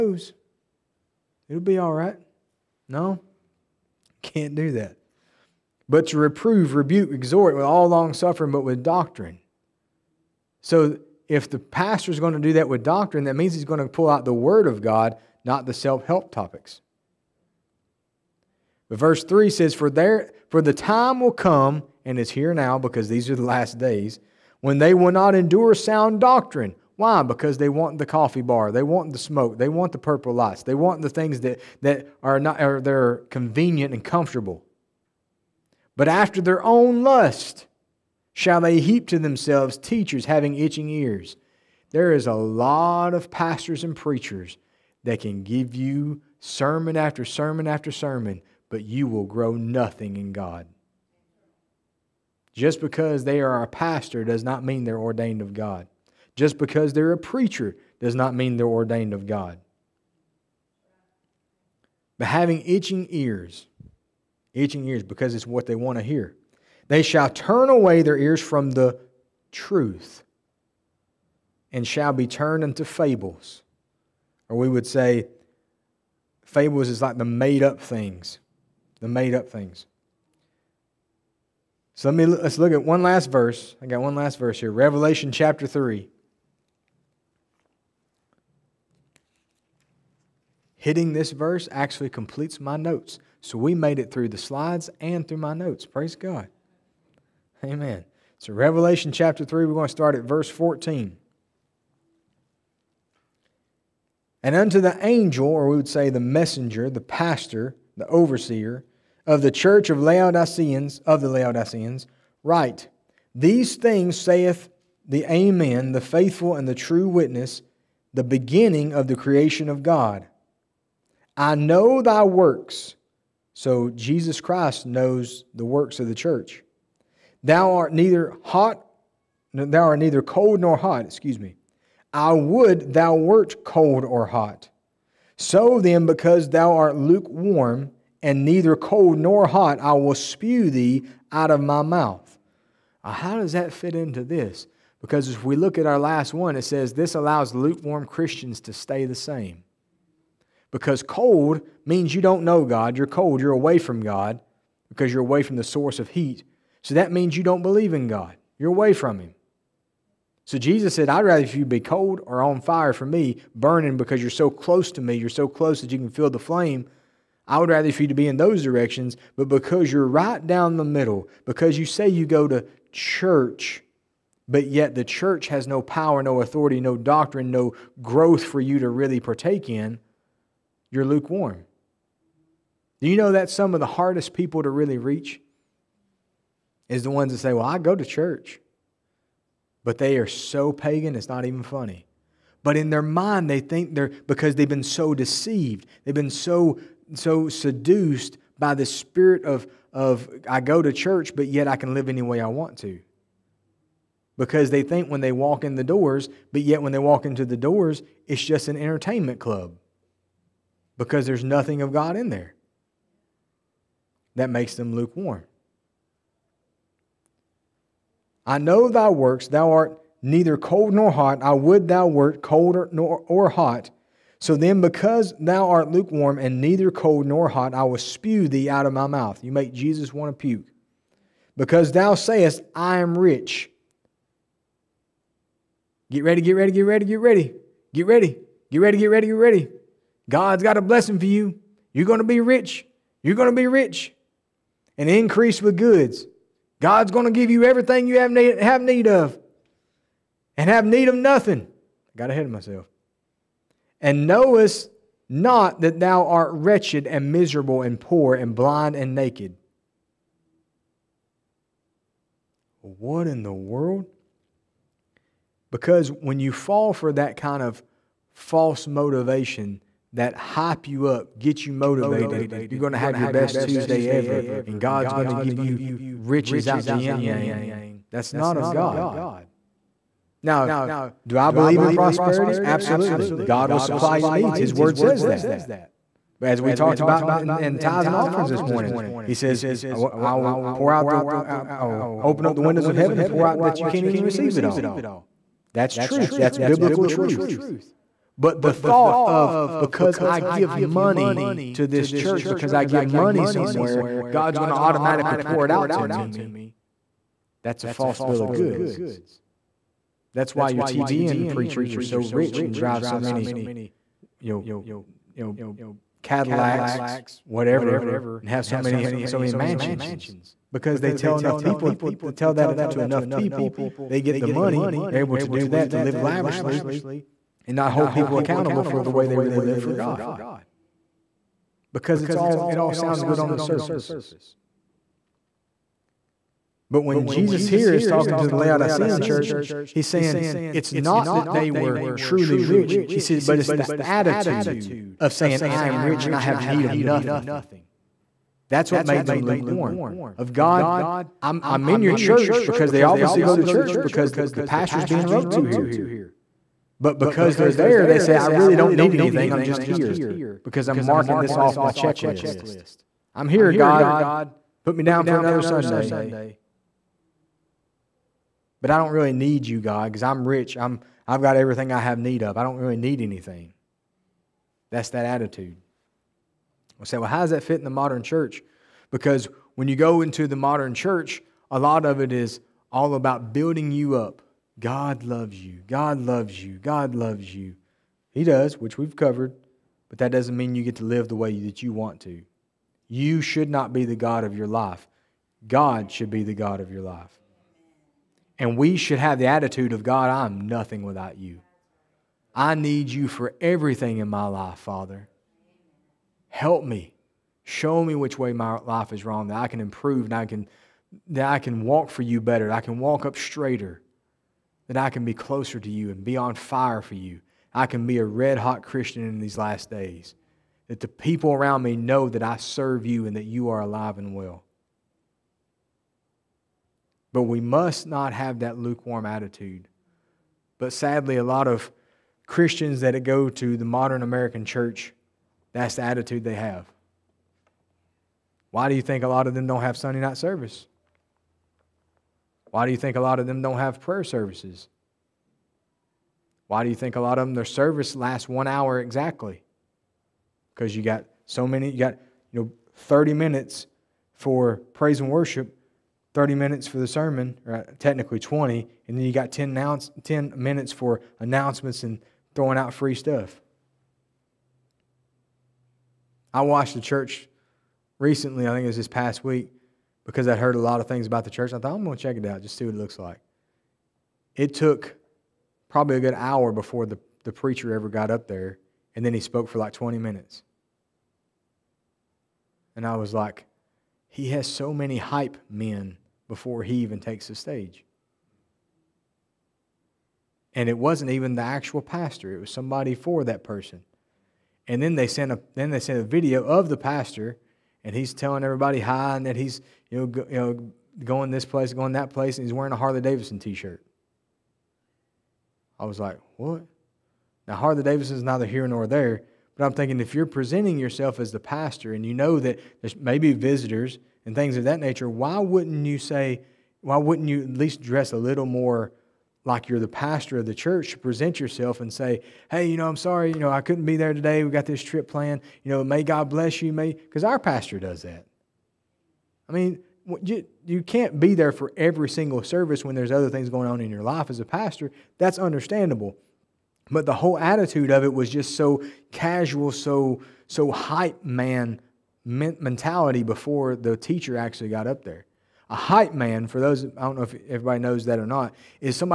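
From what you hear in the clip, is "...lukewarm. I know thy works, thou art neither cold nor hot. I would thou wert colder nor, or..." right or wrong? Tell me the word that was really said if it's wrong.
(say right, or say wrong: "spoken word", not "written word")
right.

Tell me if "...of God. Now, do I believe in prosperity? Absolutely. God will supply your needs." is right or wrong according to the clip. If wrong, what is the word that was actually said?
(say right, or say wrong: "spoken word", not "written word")
right.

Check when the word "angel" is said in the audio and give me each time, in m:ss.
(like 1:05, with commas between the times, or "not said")
1:45.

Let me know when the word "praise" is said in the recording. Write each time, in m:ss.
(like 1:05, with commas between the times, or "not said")
1:35, 7:34.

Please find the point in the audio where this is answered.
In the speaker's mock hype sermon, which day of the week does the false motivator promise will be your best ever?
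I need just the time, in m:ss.
4:33.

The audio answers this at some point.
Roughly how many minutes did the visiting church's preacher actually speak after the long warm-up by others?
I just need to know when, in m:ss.
7:59.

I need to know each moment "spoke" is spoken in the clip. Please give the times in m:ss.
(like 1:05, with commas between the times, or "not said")
7:59.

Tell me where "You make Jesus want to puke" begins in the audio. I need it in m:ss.
3:49.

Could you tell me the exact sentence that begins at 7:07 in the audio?
But we must not have that lukewarm attitude.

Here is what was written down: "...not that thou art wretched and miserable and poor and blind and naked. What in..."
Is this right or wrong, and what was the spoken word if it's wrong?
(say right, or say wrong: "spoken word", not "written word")
right.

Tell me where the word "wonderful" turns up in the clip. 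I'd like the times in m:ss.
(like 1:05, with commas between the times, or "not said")
not said.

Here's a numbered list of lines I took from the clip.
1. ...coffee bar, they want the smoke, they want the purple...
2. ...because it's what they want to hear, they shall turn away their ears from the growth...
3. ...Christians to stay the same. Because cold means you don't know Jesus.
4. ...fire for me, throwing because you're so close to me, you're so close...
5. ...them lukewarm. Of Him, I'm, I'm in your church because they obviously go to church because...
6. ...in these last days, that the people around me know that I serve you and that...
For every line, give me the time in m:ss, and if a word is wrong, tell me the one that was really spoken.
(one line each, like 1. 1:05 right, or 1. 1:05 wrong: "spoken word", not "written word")
1. 0:28 right
2. 1:05 wrong: "truth", not "growth"
3. 2:28 wrong: "God", not "Jesus"
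4. 2:42 wrong: "burning", not "throwing"
5. 5:49 wrong: "God", not "Him"
6. 6:59 right.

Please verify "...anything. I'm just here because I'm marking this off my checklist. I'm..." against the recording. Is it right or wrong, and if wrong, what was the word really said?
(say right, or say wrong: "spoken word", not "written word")
right.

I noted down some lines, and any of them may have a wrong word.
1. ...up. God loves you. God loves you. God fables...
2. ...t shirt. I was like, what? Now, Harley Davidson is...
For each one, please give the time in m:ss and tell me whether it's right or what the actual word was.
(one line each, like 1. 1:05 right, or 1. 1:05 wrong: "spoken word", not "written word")
1. 6:24 wrong: "loves", not "fables"
2. 8:23 right.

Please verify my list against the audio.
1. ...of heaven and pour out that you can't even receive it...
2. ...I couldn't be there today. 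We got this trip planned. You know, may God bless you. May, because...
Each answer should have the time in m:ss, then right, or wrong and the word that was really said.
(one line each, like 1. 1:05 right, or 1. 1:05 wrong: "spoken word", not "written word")
1. 4:52 right
2. 8:43 right.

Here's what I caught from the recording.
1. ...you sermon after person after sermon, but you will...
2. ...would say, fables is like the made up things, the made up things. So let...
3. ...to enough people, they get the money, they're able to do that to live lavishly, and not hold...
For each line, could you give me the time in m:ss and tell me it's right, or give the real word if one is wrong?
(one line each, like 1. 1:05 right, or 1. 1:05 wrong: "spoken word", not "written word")
1. 0:45 wrong: "sermon", not "person"
2. 1:14 right
3. 5:22 right.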